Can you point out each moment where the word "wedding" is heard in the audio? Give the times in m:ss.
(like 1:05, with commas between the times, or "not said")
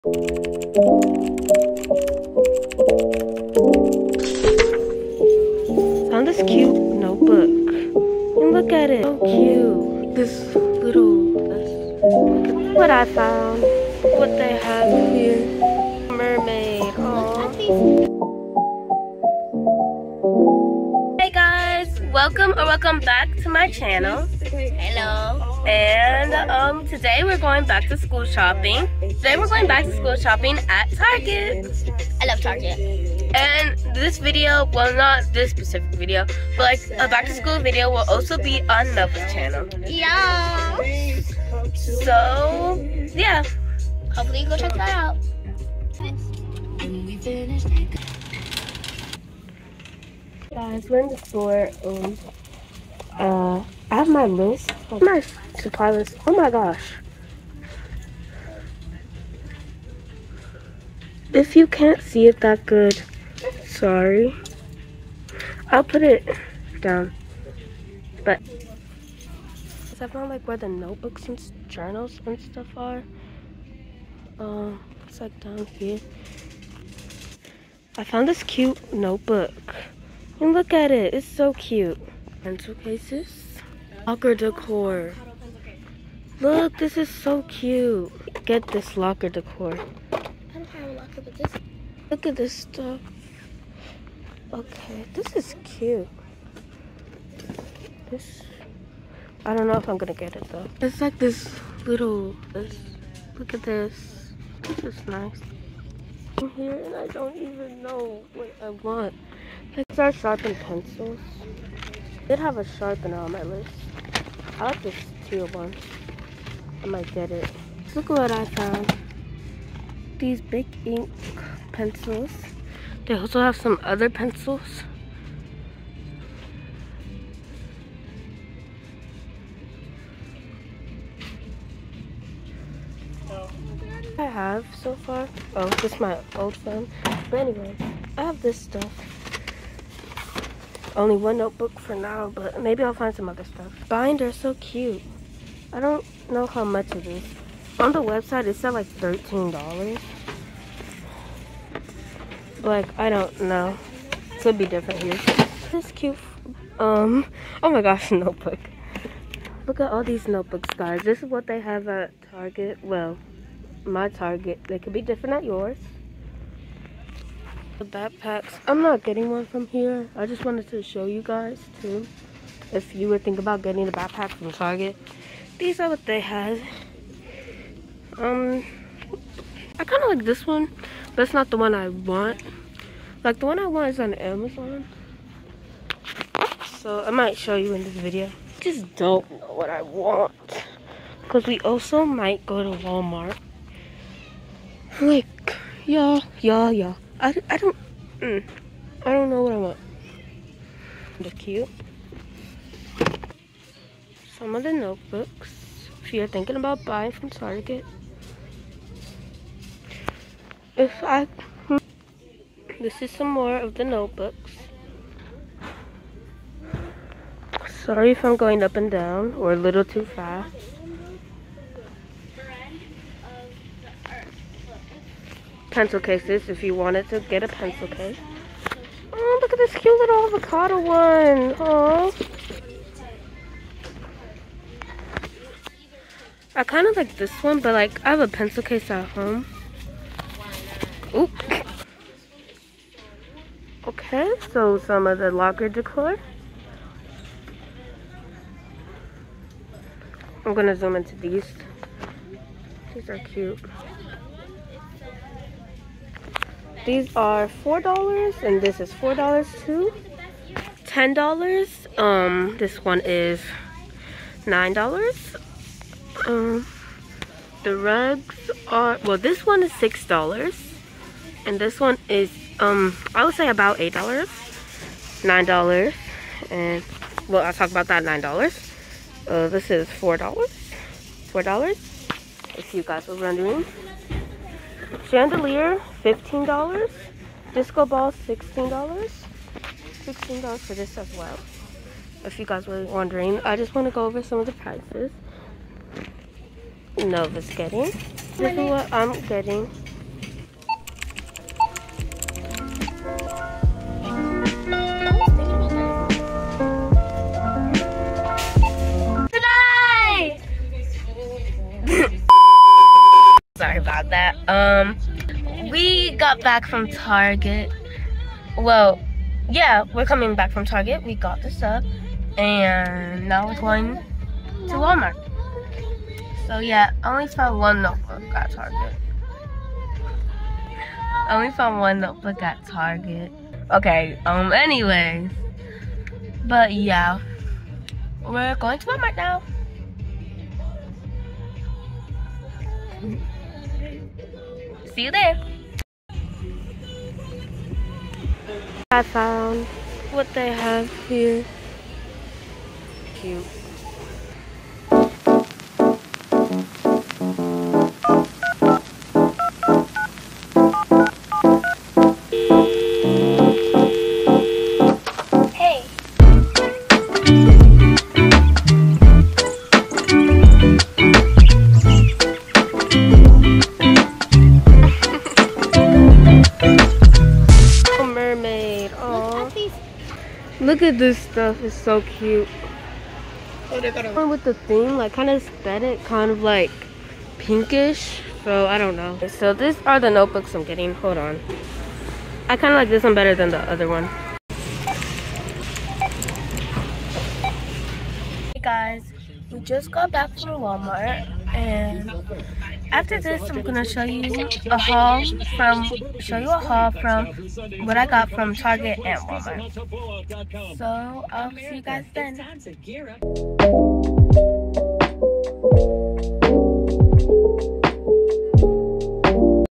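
not said.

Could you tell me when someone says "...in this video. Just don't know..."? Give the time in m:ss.
3:07.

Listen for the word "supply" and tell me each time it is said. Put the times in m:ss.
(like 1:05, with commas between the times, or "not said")
0:55.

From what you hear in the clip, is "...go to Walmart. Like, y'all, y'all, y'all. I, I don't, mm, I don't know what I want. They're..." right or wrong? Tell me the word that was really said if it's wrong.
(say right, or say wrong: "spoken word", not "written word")
right.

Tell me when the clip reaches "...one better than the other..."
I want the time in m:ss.
6:33.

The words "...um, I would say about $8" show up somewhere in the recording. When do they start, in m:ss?
4:32.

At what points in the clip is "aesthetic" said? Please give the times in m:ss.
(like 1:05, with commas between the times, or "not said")
6:25.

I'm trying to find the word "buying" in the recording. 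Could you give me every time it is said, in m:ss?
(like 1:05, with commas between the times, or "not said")
3:26.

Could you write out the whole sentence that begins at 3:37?
Sorry if I'm going up and down or a little too fast.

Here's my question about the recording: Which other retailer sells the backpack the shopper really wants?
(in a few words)
Amazon.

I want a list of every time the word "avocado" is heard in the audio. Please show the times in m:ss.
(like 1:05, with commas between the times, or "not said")
3:50.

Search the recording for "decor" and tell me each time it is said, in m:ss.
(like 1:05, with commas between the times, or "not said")
1:24, 1:29, 4:05.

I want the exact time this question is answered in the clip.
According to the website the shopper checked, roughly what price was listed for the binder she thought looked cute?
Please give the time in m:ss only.
2:28.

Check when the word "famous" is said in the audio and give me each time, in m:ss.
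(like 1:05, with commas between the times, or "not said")
not said.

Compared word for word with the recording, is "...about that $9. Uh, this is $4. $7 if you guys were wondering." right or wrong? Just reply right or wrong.
wrong.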